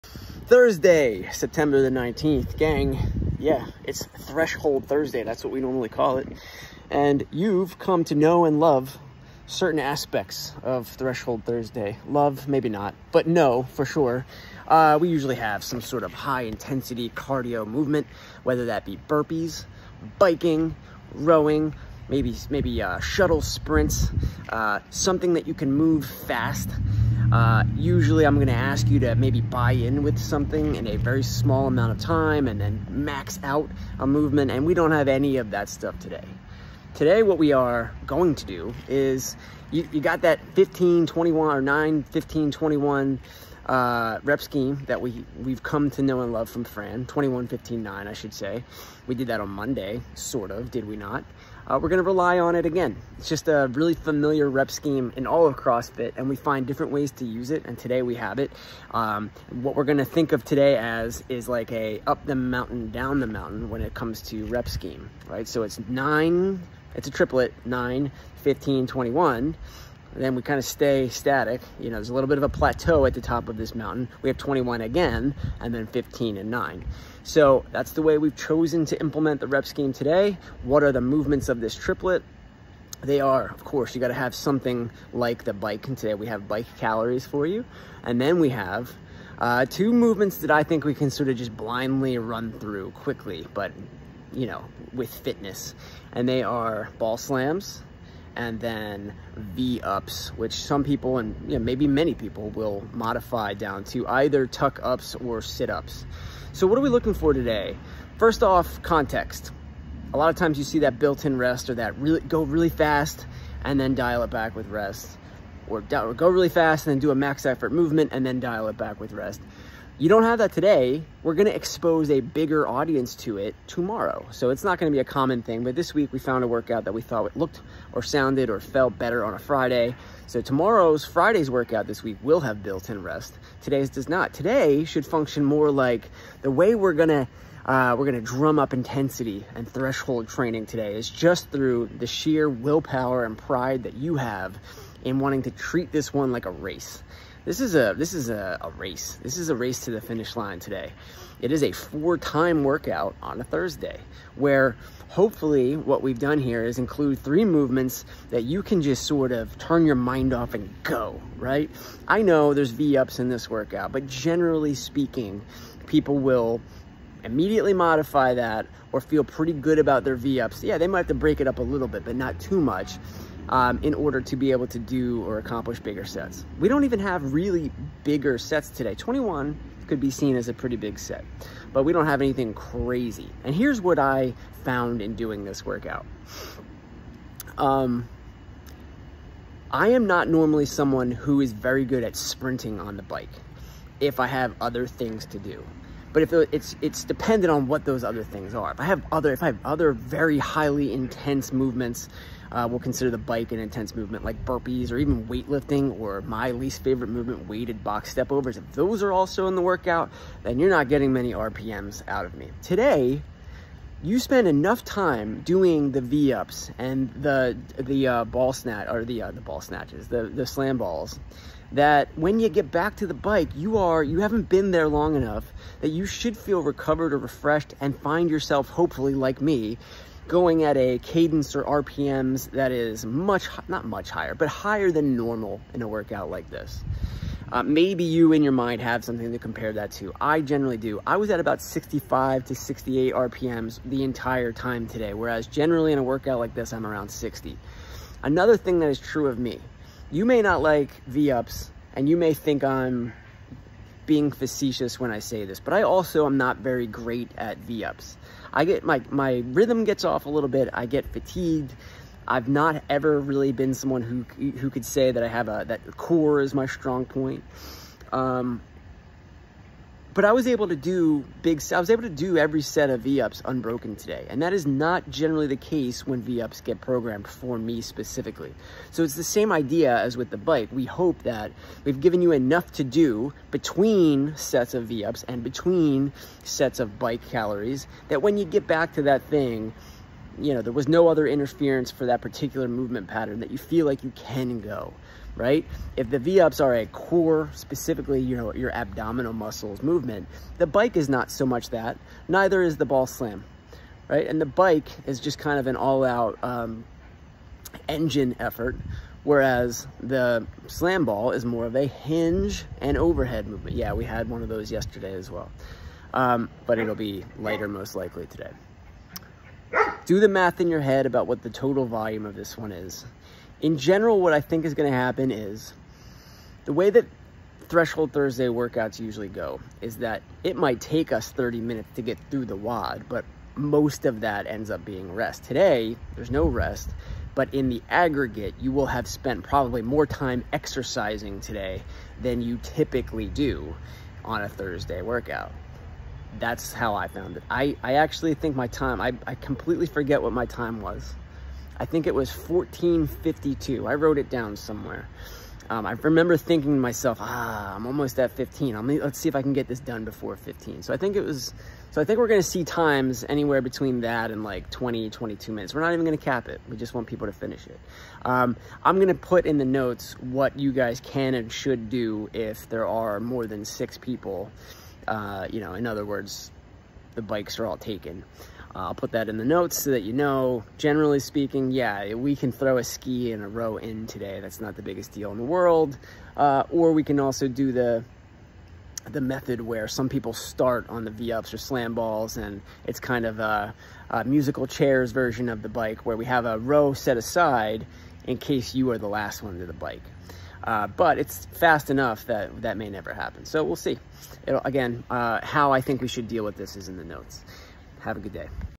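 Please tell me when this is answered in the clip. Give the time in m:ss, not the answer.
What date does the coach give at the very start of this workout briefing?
0:01.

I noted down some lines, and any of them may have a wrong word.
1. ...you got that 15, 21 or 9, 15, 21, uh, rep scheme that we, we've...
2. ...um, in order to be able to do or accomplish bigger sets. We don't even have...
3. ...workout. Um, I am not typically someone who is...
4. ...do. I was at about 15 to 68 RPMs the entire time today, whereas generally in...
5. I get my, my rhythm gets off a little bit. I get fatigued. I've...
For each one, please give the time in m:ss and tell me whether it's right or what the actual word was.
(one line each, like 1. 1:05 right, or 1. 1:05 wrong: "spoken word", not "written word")
1. 0:39 right
2. 2:53 right
3. 3:05 wrong: "normally", not "typically"
4. 4:00 wrong: "65", not "15"
5. 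4:18 right.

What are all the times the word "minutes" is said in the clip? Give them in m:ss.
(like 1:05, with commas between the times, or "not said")
5:31, 6:05.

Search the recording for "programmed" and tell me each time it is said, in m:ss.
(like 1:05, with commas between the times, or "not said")
4:36.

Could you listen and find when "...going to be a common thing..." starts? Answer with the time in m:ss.
2:04.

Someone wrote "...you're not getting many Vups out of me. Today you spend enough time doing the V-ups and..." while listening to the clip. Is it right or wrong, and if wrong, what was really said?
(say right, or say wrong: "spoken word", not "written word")
wrong: "RPMs", not "Vups".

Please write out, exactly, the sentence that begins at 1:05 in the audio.
So it's nine, it's a triplet, nine, 15, 21, then we kind of stay static.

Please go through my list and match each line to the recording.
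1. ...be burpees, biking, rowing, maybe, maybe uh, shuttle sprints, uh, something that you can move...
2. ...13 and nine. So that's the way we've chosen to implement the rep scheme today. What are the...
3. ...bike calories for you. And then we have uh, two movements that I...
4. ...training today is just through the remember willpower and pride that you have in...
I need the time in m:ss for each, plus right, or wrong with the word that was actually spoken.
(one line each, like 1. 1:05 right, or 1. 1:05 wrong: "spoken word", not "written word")
1. 0:18 right
2. 1:15 wrong: "15", not "13"
3. 1:26 right
4. 2:20 wrong: "sheer", not "remember".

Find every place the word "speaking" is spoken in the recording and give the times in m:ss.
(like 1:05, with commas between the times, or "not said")
2:44, 6:21.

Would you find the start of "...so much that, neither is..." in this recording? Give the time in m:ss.
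5:01.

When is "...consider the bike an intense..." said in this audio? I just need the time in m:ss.
3:22.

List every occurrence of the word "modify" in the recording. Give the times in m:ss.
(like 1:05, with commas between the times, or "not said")
1:42, 2:47.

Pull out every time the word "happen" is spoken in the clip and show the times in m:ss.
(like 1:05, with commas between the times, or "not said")
5:24, 6:43.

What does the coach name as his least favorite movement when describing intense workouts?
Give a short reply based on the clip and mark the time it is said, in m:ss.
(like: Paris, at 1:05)
Weighted box step overs, at 3:27.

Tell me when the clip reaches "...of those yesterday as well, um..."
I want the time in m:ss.
5:14.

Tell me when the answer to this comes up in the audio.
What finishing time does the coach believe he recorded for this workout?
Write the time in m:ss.
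5:52.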